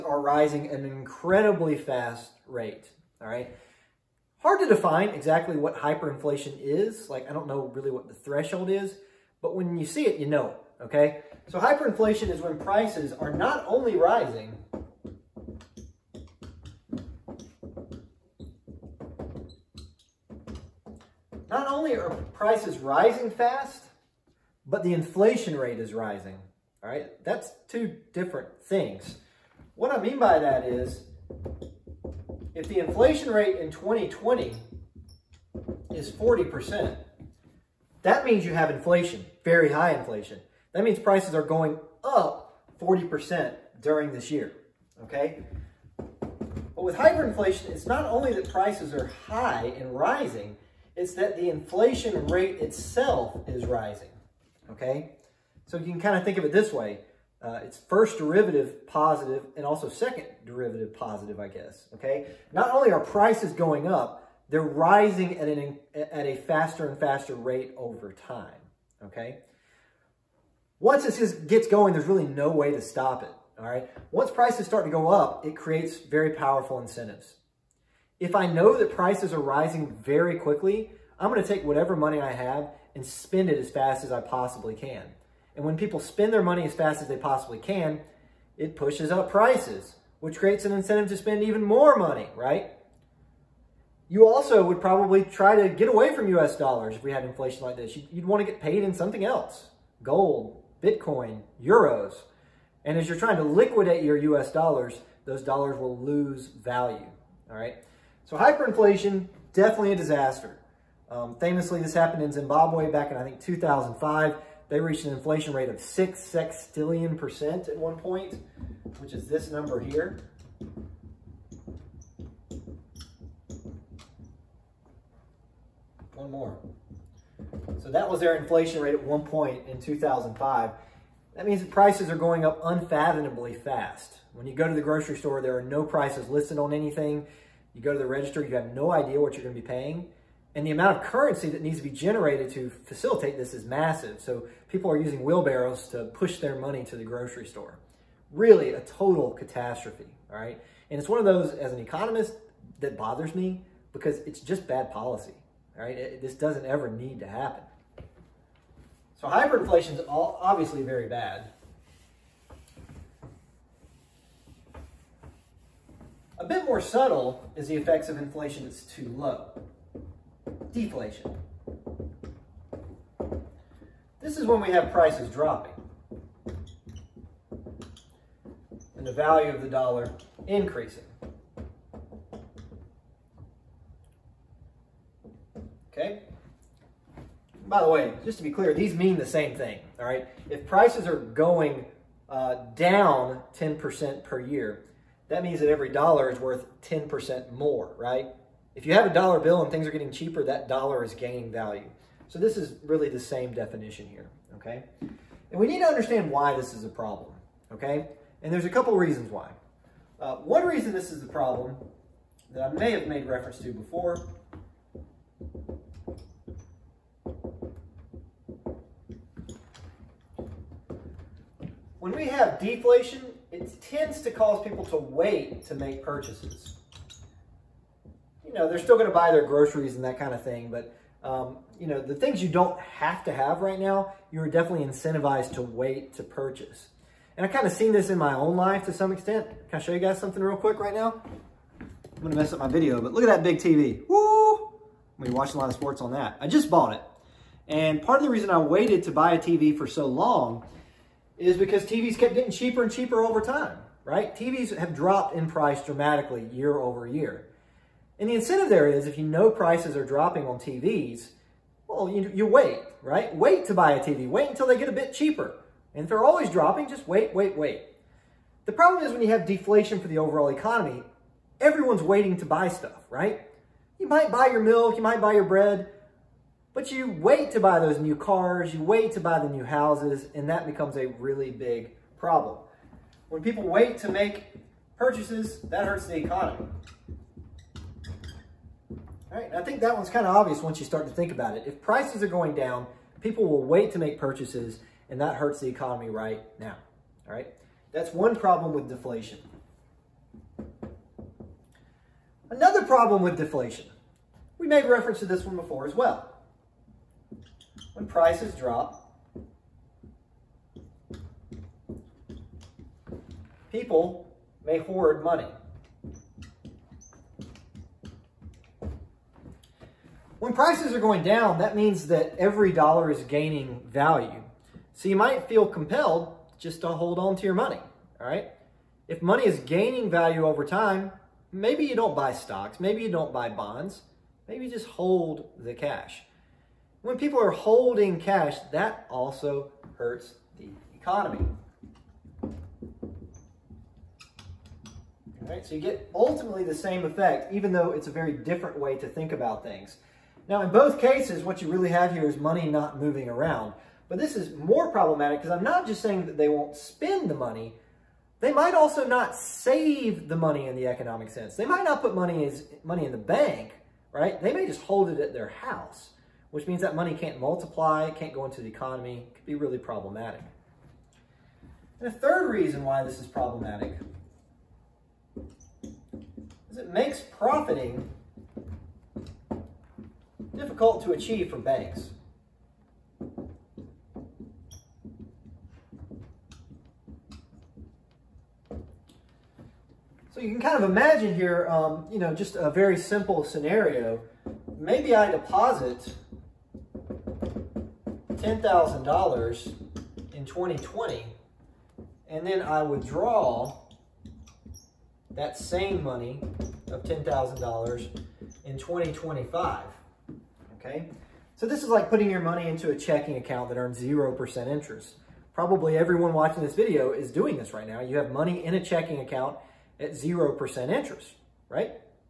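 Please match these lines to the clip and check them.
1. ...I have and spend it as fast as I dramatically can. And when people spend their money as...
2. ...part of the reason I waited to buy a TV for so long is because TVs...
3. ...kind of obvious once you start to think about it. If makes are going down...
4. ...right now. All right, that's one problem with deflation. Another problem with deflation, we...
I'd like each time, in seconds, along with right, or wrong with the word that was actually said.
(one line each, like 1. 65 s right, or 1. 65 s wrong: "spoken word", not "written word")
1. 82 s wrong: "possibly", not "dramatically"
2. 248 s right
3. 290 s wrong: "prices", not "makes"
4. 296 s right.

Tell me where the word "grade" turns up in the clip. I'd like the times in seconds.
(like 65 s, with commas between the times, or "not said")
not said.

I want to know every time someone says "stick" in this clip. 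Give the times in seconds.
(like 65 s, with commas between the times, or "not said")
not said.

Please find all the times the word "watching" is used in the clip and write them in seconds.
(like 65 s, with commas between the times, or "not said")
245 s, 416 s.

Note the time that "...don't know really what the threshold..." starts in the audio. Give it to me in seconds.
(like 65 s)
7 s.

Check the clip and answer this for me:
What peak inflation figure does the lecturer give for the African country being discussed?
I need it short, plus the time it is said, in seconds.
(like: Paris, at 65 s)
6 sextillion percent, at 115 s.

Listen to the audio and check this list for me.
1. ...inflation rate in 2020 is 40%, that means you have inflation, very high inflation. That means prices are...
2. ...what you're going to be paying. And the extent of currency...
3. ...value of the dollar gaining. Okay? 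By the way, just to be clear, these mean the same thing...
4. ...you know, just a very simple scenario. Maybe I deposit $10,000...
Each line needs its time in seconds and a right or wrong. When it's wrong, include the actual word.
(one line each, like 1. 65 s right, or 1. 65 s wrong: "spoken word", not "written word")
1. 32 s right
2. 139 s wrong: "amount", not "extent"
3. 179 s wrong: "increasing", not "gaining"
4. 392 s right.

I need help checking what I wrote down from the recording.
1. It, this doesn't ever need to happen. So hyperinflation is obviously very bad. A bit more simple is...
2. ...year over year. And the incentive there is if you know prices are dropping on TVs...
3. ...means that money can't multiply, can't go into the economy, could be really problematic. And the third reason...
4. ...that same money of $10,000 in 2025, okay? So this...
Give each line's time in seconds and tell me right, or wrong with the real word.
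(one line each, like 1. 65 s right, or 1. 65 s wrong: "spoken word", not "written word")
1. 155 s wrong: "subtle", not "simple"
2. 256 s right
3. 366 s right
4. 405 s right.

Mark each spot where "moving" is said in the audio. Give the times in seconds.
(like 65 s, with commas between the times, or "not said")
353 s.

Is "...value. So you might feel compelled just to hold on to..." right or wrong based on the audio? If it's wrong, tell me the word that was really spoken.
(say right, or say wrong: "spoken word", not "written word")
right.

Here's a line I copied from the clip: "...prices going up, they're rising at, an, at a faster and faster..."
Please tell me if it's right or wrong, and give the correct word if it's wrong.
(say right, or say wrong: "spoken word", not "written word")
right.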